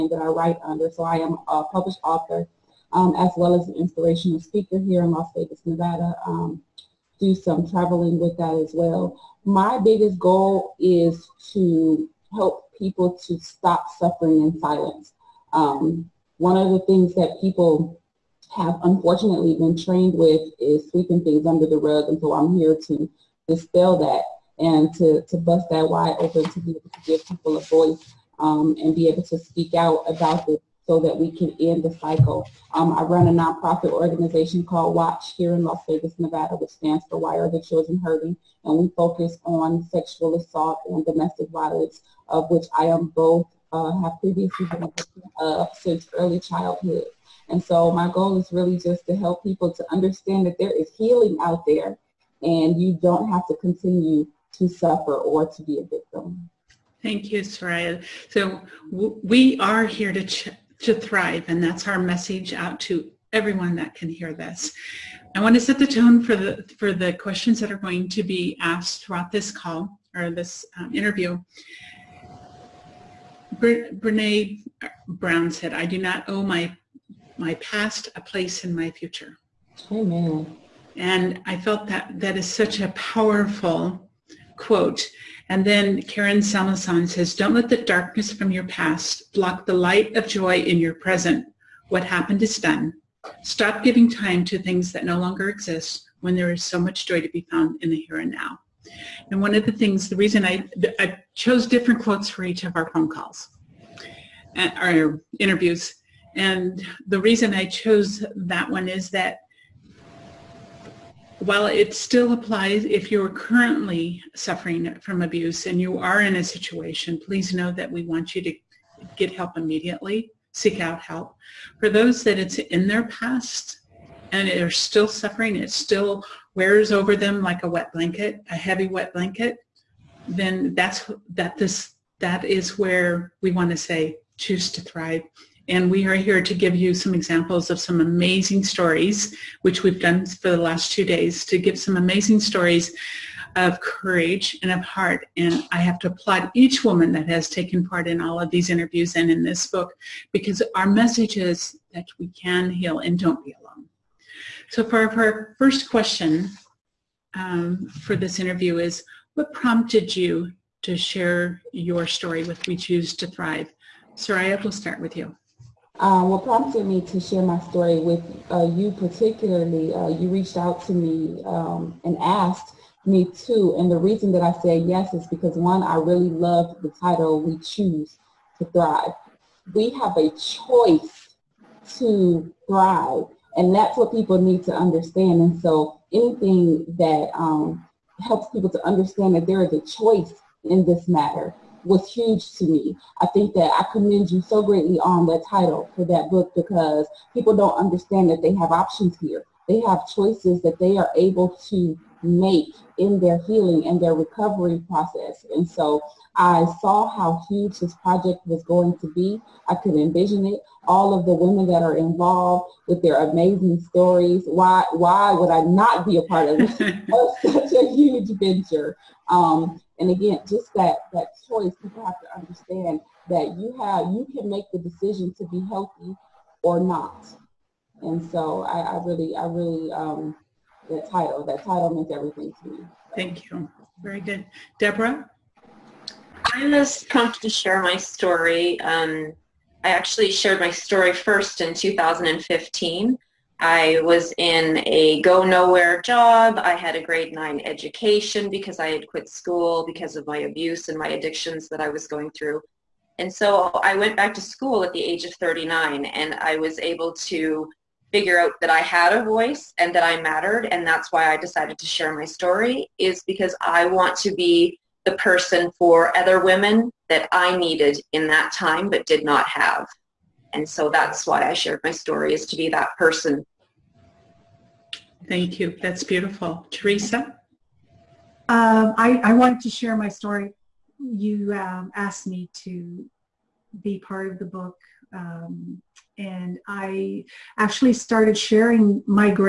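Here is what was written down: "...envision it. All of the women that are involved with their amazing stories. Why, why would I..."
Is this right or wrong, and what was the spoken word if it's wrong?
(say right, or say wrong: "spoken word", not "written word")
right.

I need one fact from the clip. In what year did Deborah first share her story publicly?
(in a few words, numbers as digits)
2015.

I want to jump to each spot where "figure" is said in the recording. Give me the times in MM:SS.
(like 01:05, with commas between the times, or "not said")
04:18.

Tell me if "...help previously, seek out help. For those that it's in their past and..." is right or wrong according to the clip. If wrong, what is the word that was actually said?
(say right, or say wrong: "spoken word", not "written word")
wrong: "immediately", not "previously".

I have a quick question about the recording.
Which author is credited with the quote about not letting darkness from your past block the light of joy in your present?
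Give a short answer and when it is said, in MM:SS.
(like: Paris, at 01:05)
Karen Salmansohn, at 01:26.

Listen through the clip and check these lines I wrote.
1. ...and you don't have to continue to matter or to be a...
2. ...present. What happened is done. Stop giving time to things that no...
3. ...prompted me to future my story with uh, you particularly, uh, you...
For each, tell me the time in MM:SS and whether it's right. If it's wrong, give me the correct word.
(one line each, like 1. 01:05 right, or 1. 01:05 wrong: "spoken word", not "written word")
1. 00:52 wrong: "suffer", not "matter"
2. 01:30 right
3. 02:46 wrong: "share", not "future".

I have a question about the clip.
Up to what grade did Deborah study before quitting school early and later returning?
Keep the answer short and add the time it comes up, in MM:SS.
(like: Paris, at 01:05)
Grade 9, at 04:07.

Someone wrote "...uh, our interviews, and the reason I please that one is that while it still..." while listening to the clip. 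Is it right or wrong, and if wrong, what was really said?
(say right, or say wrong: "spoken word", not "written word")
wrong: "chose", not "please".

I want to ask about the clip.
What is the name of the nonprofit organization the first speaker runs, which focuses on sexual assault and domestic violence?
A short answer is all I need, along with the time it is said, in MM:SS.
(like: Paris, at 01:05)
WATCH, at 00:34.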